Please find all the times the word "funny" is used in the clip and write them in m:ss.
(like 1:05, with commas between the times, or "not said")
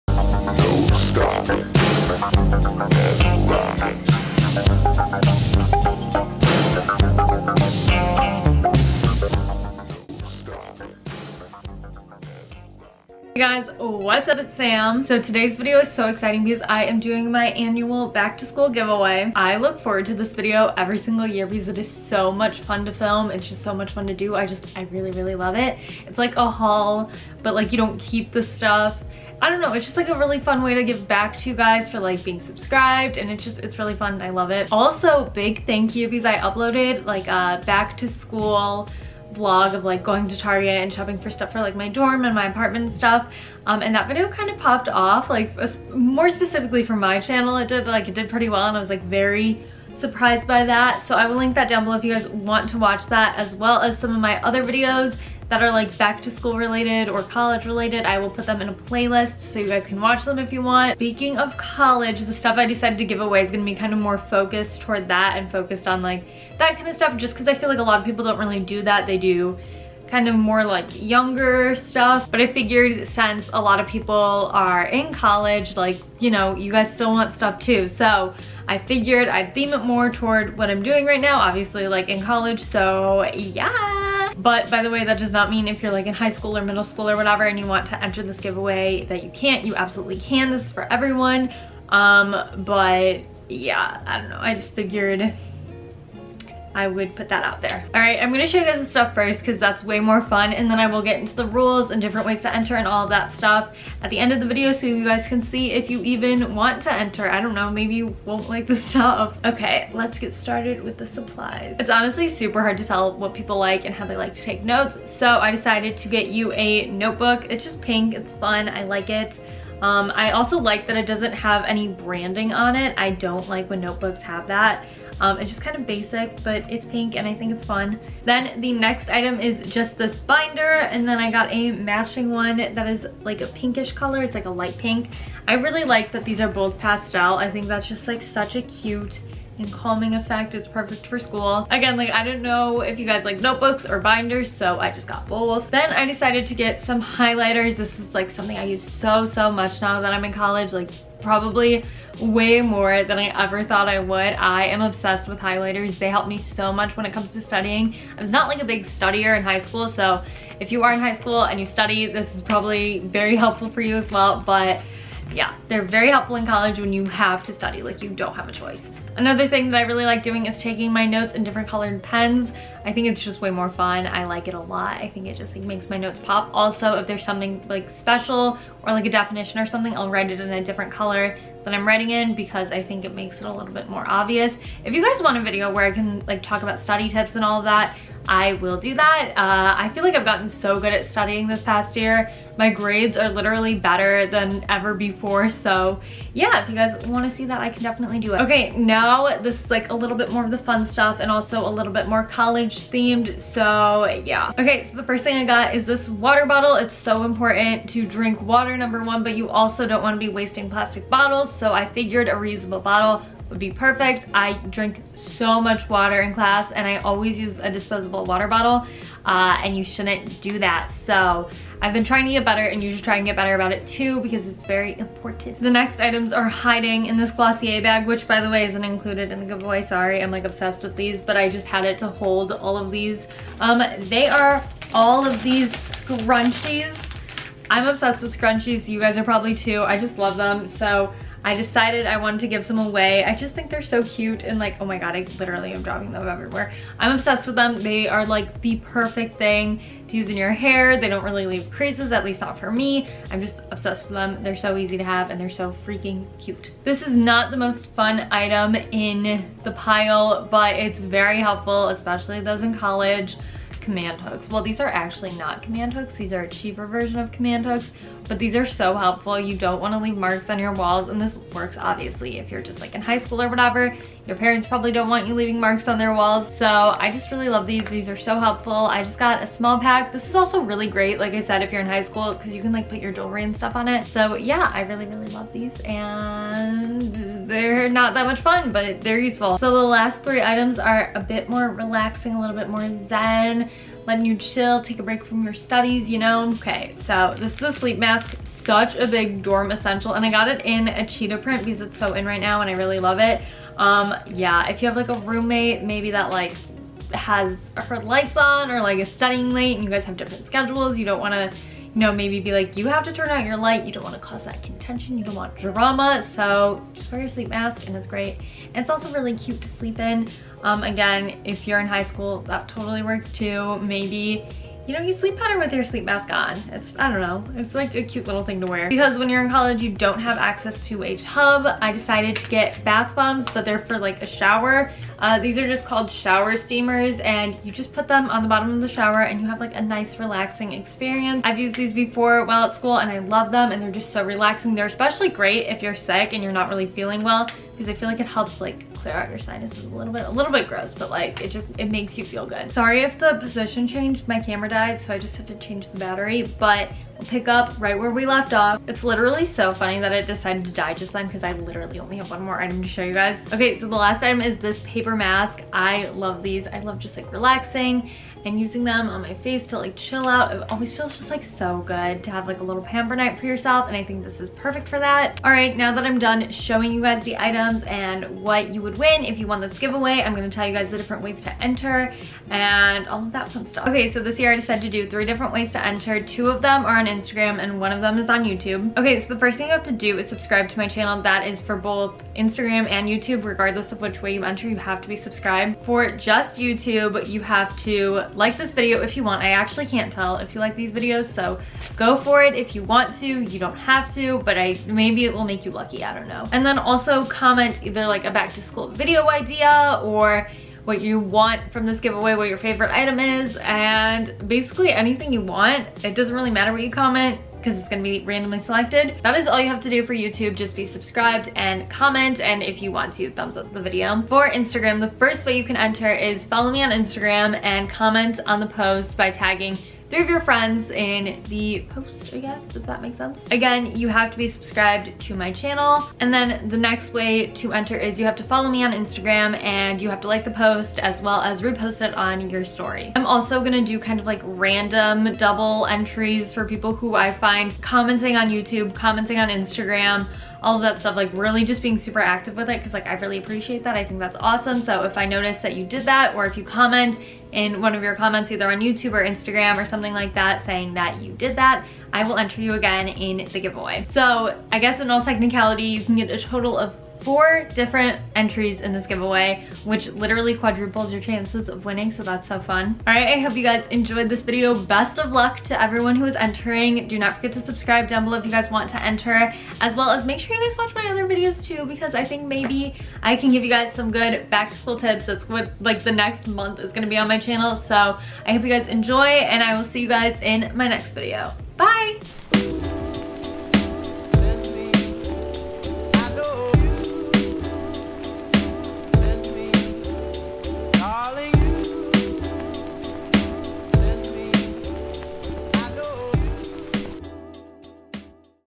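5:59.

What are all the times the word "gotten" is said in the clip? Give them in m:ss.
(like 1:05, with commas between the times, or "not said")
3:10.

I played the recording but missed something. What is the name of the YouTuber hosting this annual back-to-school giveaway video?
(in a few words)
Sam.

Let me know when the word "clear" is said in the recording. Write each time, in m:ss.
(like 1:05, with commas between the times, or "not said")
5:49.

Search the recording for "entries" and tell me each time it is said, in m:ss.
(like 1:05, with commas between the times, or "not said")
7:25, 7:48.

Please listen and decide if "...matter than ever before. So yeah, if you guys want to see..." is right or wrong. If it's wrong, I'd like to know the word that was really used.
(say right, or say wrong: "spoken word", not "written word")
wrong: "better", not "matter".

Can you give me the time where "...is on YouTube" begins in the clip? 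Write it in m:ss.
6:28.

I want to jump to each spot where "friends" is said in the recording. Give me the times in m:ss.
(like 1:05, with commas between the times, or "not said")
7:10.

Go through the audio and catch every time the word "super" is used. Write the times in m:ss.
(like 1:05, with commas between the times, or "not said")
1:52, 7:31.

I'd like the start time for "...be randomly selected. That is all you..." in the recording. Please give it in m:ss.
6:58.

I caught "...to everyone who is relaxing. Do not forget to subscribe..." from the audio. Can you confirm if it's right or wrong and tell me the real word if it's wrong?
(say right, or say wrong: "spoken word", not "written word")
wrong: "entering", not "relaxing".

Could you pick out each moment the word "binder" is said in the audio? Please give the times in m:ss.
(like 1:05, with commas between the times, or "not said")
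2:10, 2:23.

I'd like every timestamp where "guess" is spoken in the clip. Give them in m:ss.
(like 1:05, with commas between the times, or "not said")
7:12, 7:44.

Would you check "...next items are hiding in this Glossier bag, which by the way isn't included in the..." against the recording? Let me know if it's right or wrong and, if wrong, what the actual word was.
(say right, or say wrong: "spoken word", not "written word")
right.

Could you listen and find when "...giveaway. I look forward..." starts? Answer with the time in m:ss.
0:18.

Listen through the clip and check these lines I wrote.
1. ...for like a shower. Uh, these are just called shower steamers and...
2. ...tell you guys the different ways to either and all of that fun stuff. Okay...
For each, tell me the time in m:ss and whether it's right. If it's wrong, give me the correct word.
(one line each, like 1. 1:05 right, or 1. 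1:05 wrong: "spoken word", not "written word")
1. 5:33 right
2. 6:20 wrong: "enter", not "either".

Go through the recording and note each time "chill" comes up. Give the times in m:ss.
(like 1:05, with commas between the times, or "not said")
4:54, 6:09.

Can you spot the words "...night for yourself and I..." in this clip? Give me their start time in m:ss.
6:13.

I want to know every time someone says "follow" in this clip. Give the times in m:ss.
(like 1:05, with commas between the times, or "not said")
7:06, 7:18.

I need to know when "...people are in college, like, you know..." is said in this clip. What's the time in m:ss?
1:13.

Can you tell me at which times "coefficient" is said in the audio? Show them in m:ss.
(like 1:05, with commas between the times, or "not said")
not said.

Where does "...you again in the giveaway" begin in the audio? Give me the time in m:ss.
7:42.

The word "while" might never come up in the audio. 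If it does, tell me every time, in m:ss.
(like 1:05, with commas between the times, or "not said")
5:42.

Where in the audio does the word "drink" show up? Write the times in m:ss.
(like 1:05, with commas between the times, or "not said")
3:28, 3:34.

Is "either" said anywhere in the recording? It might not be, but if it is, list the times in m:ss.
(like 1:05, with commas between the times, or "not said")
6:47, 7:38.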